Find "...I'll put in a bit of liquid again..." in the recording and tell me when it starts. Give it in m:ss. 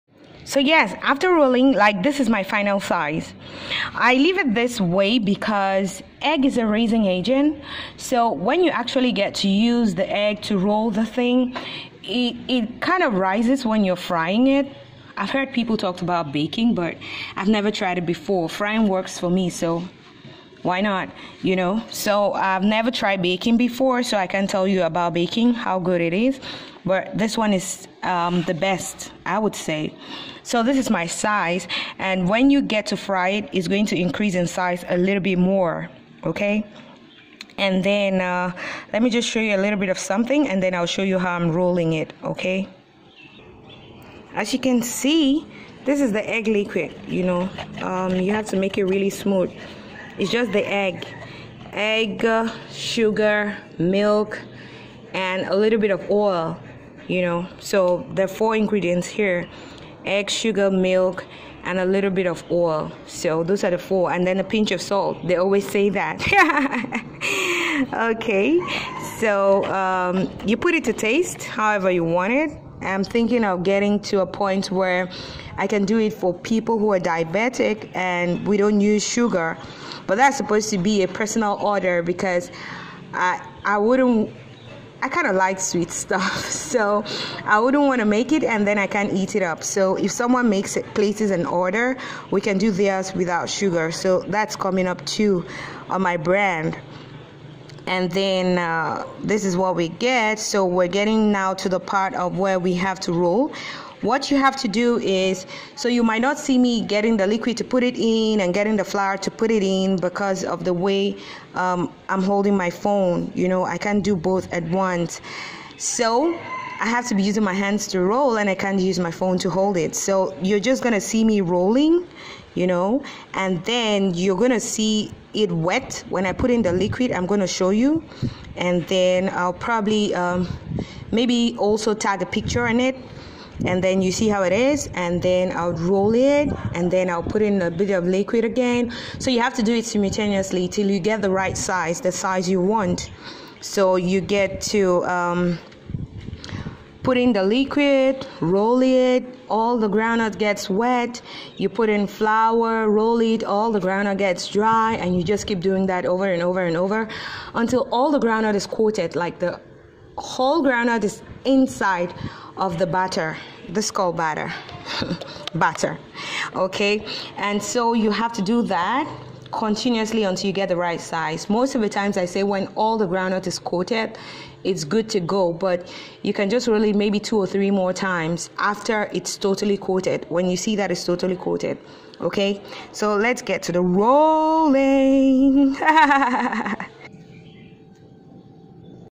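2:17.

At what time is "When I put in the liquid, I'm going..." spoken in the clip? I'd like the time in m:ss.
2:06.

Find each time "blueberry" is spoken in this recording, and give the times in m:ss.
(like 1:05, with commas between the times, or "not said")
not said.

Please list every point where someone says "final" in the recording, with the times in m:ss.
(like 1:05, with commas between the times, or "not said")
0:02.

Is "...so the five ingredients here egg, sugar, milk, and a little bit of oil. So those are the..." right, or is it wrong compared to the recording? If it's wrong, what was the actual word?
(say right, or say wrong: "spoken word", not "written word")
wrong: "four", not "five".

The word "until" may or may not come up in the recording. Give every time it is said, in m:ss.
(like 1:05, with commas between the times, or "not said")
2:37, 2:50.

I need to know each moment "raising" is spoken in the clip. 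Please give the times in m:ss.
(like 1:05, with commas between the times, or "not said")
0:06.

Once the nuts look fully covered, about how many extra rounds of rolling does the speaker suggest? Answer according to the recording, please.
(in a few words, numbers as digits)
2 or 3.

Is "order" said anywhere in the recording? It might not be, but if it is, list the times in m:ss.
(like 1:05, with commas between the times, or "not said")
1:21, 1:31.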